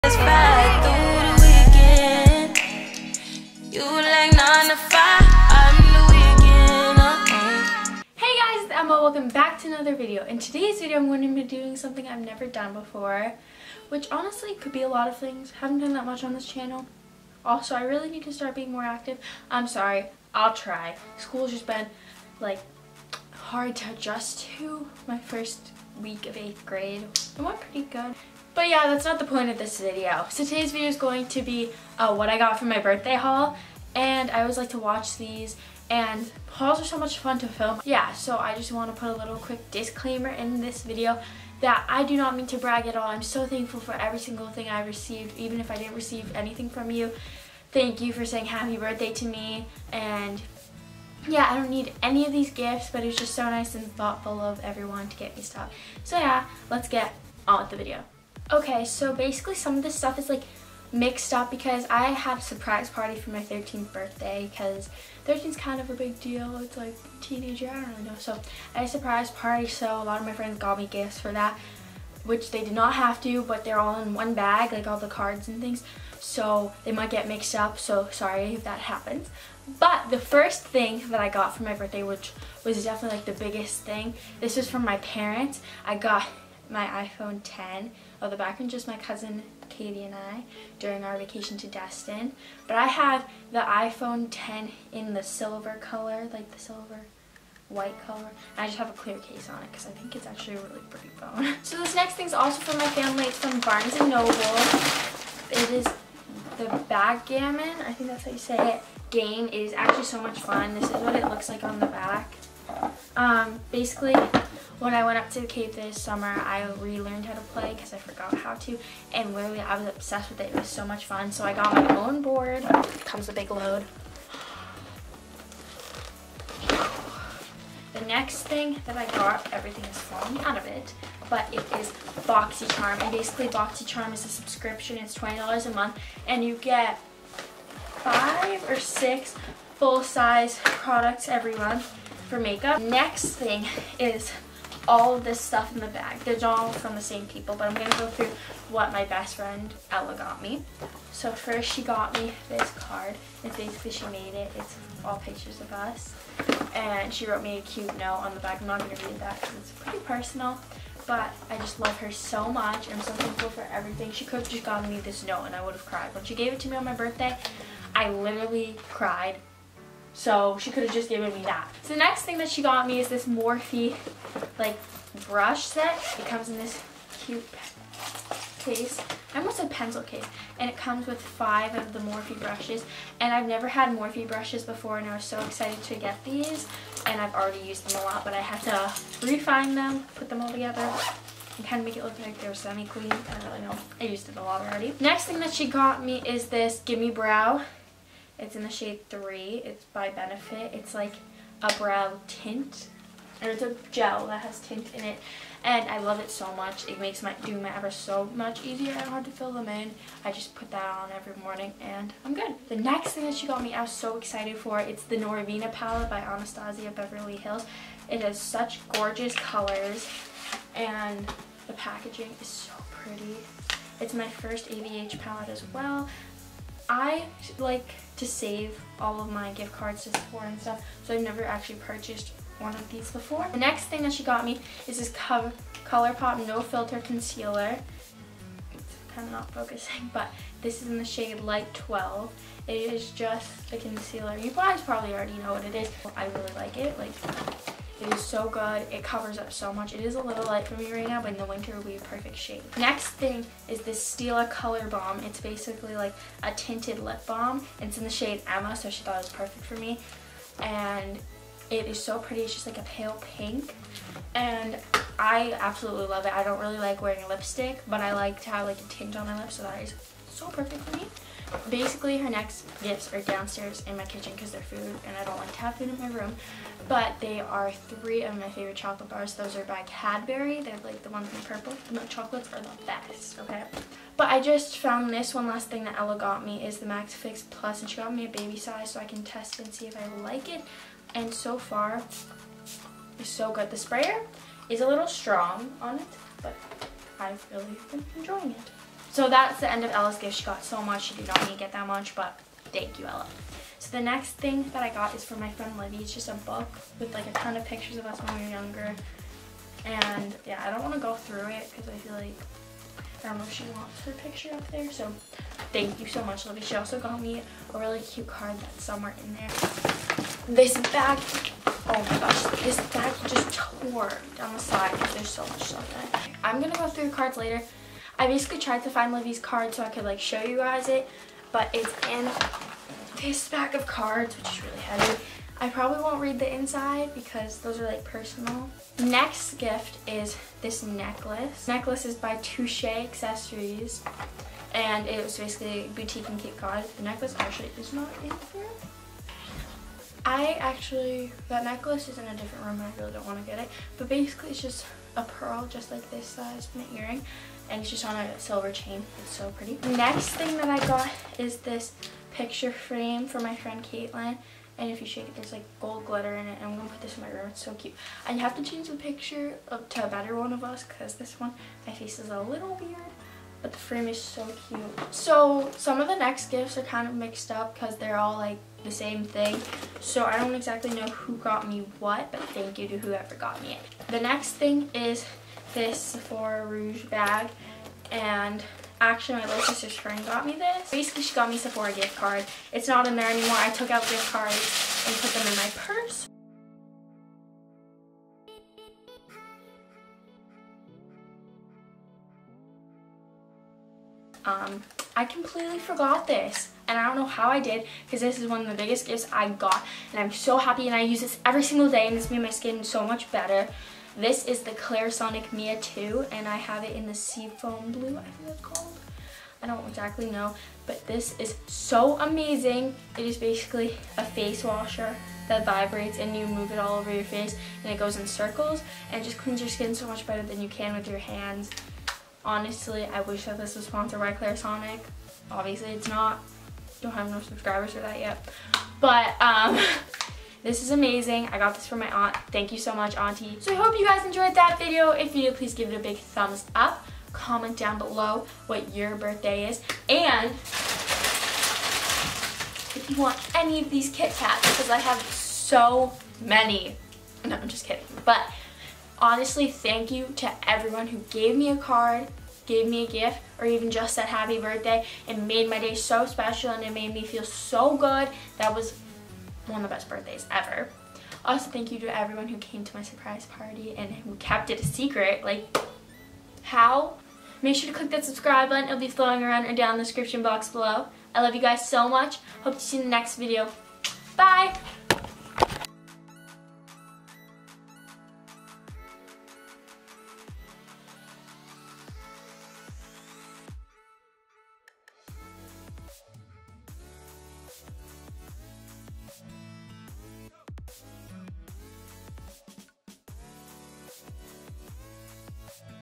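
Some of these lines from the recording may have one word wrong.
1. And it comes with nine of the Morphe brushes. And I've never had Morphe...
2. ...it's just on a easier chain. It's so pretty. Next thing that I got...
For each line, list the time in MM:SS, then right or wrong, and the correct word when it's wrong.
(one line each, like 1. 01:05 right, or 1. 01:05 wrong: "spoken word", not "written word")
1. 03:00 wrong: "five", not "nine"
2. 05:57 wrong: "silver", not "easier".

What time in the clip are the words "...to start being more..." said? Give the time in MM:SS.
00:18.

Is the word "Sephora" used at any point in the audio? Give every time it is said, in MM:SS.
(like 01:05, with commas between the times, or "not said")
03:50, 06:25, 06:31.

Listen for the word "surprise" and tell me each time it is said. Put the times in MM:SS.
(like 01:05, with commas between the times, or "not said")
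01:02, 01:08, 07:53.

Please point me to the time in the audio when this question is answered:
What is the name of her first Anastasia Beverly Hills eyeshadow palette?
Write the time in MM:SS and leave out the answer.
03:35.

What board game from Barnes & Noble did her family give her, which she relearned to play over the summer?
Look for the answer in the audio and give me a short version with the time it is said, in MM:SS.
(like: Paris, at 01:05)
Backgammon, at 01:46.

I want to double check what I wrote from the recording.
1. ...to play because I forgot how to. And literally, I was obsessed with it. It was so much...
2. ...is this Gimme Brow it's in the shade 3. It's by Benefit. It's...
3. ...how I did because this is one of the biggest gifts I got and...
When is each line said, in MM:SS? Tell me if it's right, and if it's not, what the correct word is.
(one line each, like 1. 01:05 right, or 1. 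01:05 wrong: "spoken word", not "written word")
1. 01:57 right
2. 03:16 right
3. 06:47 right.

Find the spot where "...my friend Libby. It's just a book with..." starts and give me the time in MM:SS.
05:05.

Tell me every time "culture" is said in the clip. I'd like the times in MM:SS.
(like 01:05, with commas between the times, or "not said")
not said.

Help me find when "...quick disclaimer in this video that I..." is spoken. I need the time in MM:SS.
00:39.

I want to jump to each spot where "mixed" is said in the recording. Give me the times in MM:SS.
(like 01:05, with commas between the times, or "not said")
01:00, 01:17, 06:17.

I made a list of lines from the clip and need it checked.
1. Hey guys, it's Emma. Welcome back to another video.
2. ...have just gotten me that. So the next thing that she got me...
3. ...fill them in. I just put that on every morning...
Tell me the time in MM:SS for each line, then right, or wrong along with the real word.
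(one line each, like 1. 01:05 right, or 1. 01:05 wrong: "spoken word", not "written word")
1. 00:08 right
2. 02:50 wrong: "given", not "gotten"
3. 03:29 right.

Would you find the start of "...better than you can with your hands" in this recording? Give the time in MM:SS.
07:10.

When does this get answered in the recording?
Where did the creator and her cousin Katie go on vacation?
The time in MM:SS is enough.
01:31.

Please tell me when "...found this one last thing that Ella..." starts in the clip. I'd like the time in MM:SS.
04:44.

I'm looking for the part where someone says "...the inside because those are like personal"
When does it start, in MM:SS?
05:36.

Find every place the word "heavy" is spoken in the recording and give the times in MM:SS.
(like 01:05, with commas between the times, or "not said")
05:34.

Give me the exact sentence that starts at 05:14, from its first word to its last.
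So thank you so much, Libby.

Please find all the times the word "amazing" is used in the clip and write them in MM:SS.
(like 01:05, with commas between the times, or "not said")
07:02, 07:20.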